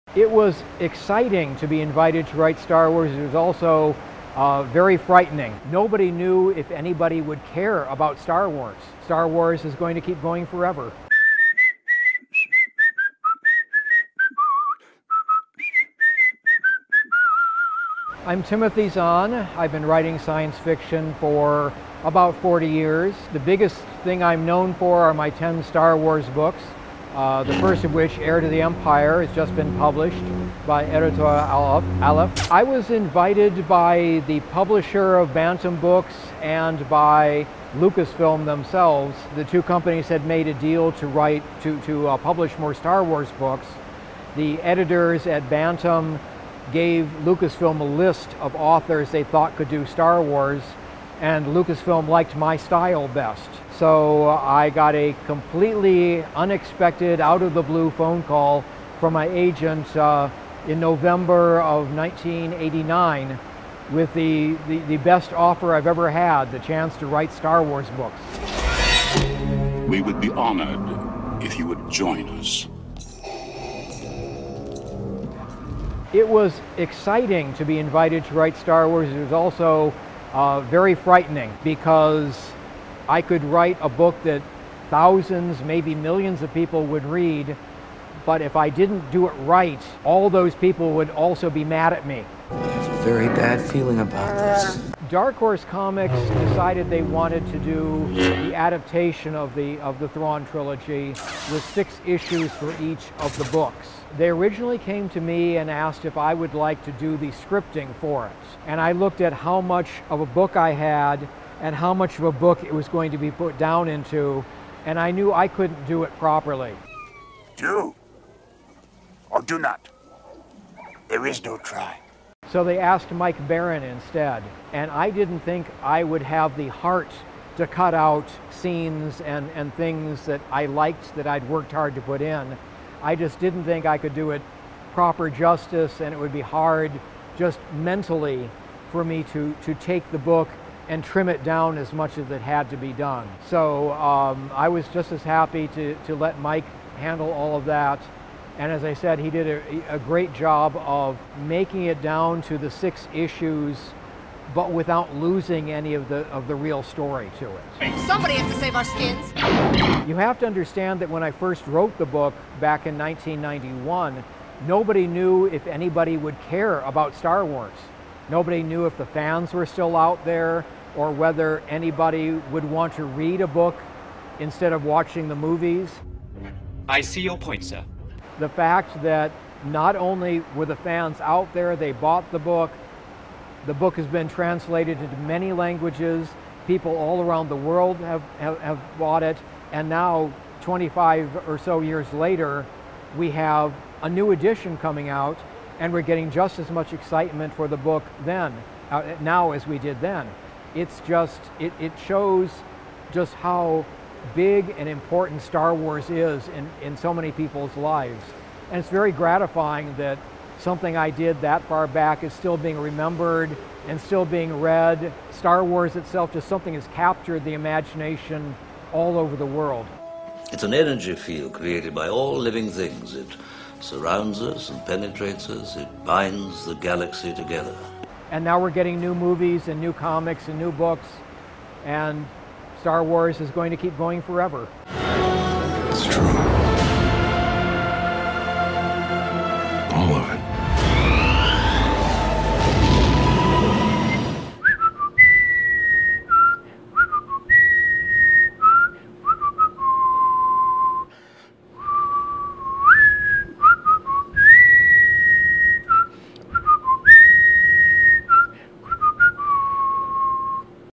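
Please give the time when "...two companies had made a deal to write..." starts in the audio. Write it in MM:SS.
00:39.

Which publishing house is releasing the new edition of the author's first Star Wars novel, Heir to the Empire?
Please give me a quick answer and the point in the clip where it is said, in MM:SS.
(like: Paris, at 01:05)
Editor Aleph, at 00:30.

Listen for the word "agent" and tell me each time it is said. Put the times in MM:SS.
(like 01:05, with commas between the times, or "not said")
00:59.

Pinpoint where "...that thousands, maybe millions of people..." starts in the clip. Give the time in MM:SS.
01:24.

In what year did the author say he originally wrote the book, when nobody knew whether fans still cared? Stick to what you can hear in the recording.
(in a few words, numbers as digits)
1991.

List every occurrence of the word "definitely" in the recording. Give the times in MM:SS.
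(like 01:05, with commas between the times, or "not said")
not said.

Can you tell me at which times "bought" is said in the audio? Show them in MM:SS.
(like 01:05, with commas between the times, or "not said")
03:01, 03:08.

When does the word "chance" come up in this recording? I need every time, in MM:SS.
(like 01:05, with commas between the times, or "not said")
01:06.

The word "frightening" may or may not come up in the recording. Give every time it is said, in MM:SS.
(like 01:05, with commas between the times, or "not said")
00:04, 01:20.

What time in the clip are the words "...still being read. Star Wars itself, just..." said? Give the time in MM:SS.
03:33.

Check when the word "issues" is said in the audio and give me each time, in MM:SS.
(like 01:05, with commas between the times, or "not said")
01:42, 02:33.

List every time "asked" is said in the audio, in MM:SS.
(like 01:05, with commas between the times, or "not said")
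01:45, 02:02.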